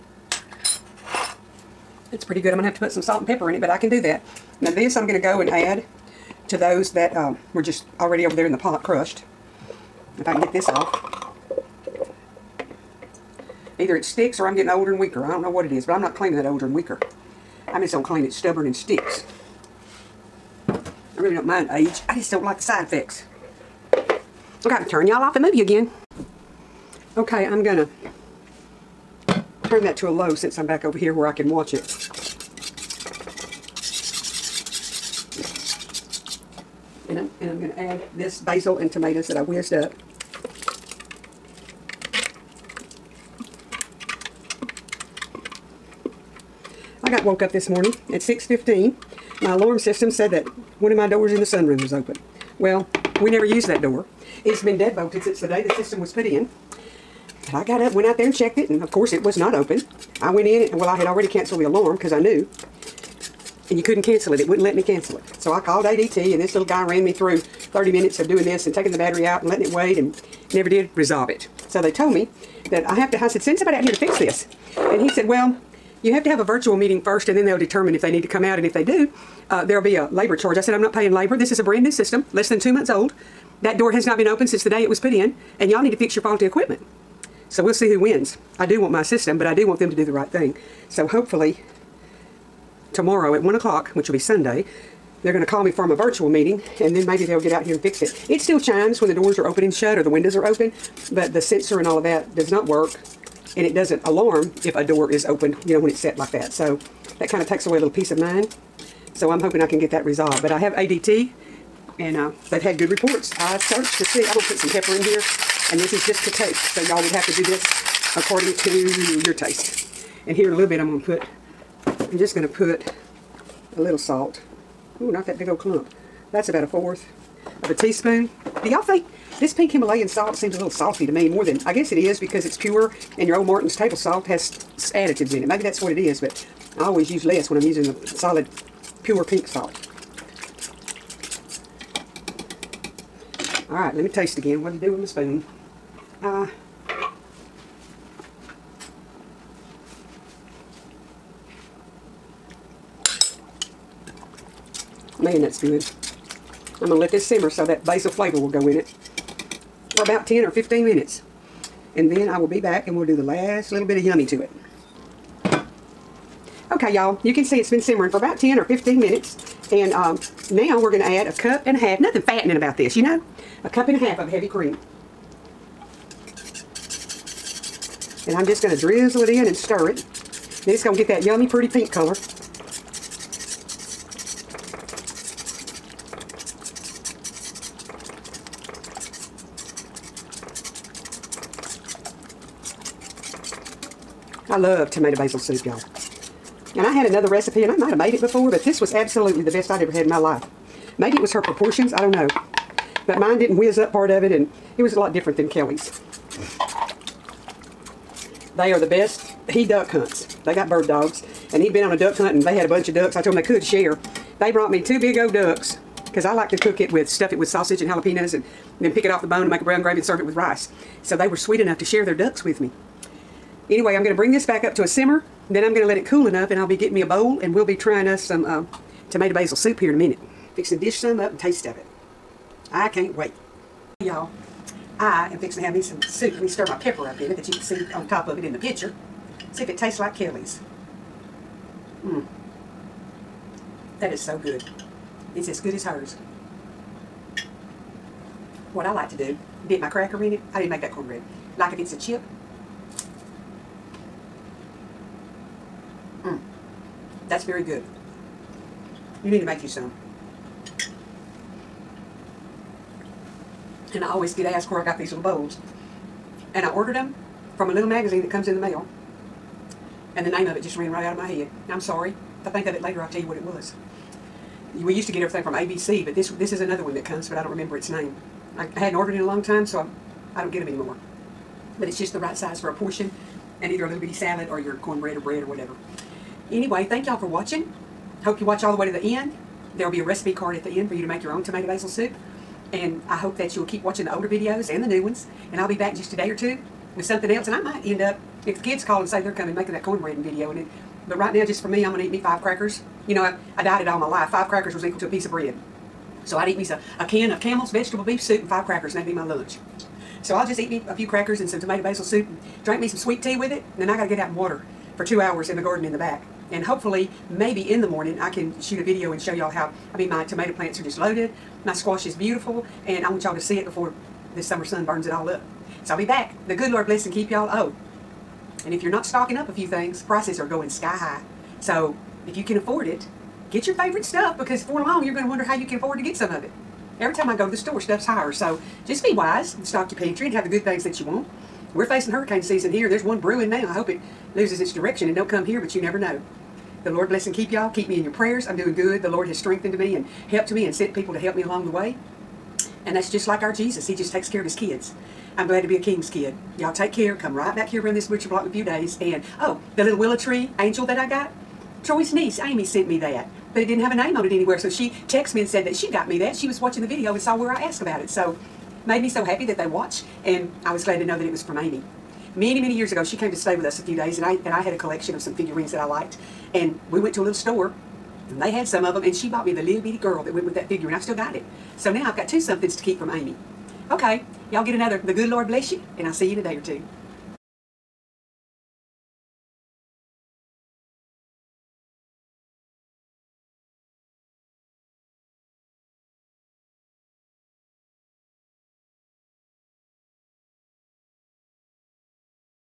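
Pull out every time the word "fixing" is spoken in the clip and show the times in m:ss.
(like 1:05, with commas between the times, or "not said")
3:50, 3:55.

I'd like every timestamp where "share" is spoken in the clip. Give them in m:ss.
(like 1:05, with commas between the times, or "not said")
3:33, 3:41.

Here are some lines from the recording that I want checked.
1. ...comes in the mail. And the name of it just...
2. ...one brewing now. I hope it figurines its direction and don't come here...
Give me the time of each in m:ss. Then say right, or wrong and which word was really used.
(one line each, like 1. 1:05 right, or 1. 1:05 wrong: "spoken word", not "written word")
1. 4:28 right
2. 5:43 wrong: "loses", not "figurines".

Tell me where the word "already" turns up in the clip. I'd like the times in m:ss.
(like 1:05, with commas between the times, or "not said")
0:07, 1:01.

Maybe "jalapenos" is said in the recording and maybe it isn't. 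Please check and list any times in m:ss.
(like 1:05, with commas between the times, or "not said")
3:37.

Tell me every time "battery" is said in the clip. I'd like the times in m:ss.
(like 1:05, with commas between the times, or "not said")
1:08.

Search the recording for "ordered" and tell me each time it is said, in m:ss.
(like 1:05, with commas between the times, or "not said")
4:26, 4:38.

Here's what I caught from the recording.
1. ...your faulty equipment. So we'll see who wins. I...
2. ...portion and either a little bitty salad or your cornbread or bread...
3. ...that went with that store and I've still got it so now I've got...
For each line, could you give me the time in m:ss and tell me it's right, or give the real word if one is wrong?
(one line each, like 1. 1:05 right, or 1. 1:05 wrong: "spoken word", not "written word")
1. 1:26 right
2. 4:42 right
3. 6:20 wrong: "figure", not "store".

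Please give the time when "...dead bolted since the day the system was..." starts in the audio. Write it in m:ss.
0:54.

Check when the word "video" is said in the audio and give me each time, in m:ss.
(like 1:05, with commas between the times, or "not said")
4:54, 5:00, 5:18, 6:06.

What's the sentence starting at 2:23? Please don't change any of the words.
All right, let me taste again.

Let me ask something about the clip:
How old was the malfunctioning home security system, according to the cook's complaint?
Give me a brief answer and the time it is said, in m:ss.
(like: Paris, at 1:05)
less than 2 months old, at 1:22.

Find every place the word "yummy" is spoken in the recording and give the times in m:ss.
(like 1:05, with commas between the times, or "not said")
2:44, 3:01.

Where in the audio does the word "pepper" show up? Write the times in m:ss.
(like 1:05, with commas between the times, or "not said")
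0:03, 1:54, 3:56.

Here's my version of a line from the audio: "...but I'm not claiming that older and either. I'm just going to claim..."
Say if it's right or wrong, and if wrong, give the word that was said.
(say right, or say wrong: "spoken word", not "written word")
wrong: "weaker", not "either".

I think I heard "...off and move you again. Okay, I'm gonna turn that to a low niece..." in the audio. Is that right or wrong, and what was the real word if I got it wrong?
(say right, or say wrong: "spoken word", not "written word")
wrong: "since", not "niece".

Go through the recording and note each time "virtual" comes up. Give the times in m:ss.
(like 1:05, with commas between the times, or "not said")
1:16, 1:35.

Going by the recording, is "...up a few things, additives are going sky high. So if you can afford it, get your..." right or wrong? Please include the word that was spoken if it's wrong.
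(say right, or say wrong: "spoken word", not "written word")
wrong: "prices", not "additives".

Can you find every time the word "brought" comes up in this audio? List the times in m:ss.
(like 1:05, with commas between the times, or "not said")
3:34.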